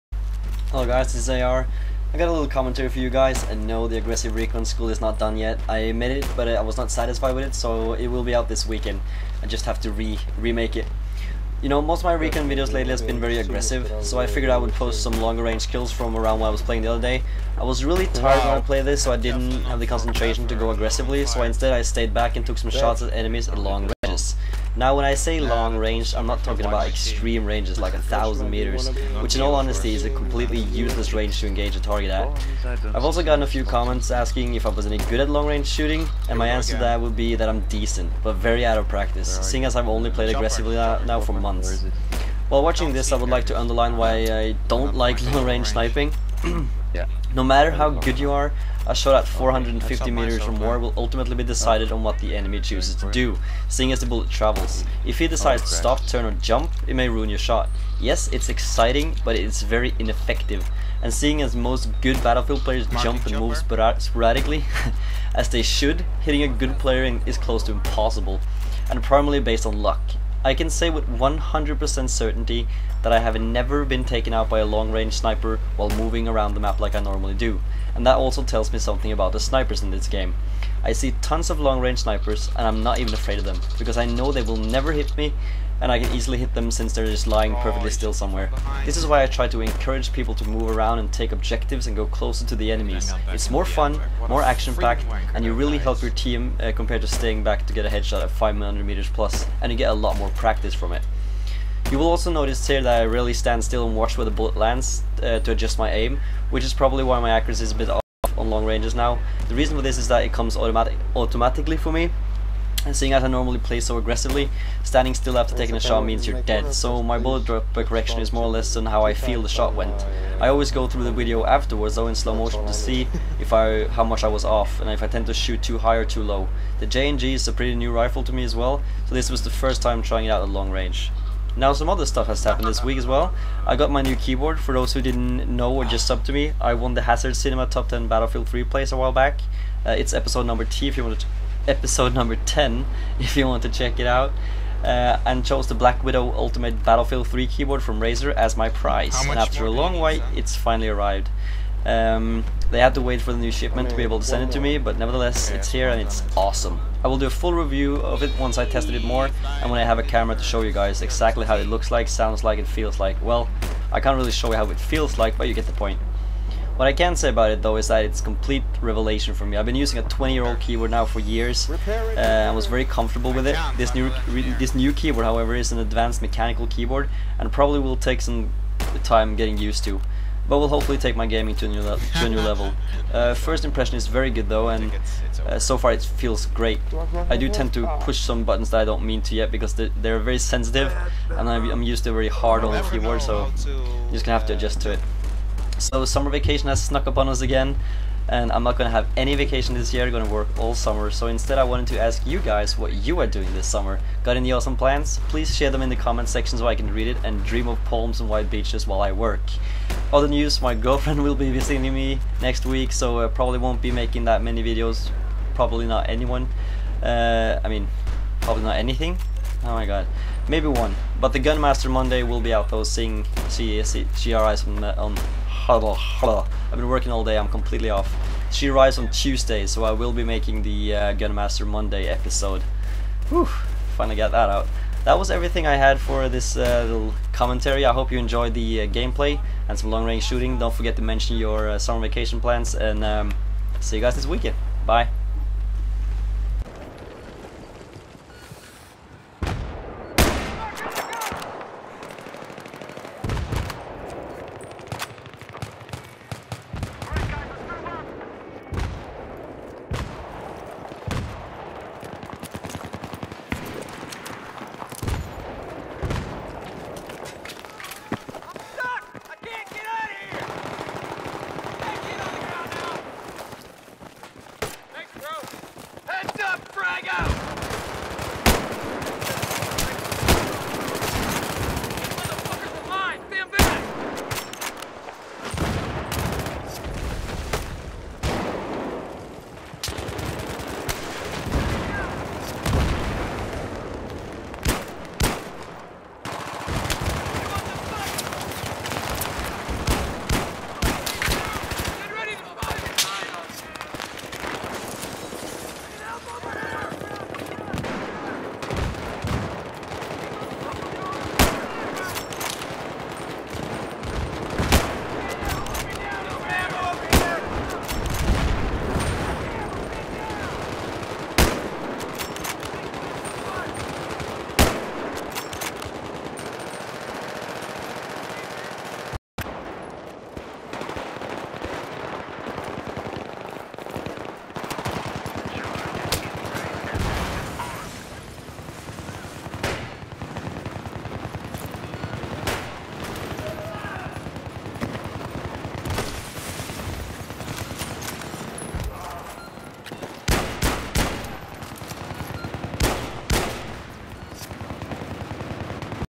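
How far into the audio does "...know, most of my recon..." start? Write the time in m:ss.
0:11.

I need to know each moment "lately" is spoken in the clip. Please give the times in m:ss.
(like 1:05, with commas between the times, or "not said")
0:12.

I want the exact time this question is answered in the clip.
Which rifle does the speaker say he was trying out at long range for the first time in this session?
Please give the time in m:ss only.
2:06.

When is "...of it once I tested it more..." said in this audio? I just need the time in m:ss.
2:37.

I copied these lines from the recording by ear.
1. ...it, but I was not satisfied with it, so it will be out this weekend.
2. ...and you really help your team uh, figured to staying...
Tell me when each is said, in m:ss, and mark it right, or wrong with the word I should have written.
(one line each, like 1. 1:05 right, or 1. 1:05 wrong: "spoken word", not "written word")
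1. 0:06 right
2. 1:35 wrong: "compared", not "figured".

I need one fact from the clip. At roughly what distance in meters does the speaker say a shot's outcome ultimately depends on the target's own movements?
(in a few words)
450.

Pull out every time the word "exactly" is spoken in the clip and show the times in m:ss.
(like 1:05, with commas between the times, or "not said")
2:41.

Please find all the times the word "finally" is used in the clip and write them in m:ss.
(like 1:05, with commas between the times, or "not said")
2:30, 3:53.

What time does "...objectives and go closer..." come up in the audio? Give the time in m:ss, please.
1:31.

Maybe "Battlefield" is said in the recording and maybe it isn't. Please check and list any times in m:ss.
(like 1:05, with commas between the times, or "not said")
1:02, 2:18, 2:26.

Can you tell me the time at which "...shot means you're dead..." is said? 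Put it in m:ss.
1:55.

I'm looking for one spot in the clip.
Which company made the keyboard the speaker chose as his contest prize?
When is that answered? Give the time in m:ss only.
2:27.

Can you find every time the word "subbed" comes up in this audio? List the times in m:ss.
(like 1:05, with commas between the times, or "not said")
2:16.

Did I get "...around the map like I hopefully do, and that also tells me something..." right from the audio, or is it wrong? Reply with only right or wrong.
wrong.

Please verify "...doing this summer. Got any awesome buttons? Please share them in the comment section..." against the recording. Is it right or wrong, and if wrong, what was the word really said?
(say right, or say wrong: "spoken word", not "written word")
wrong: "plans", not "buttons".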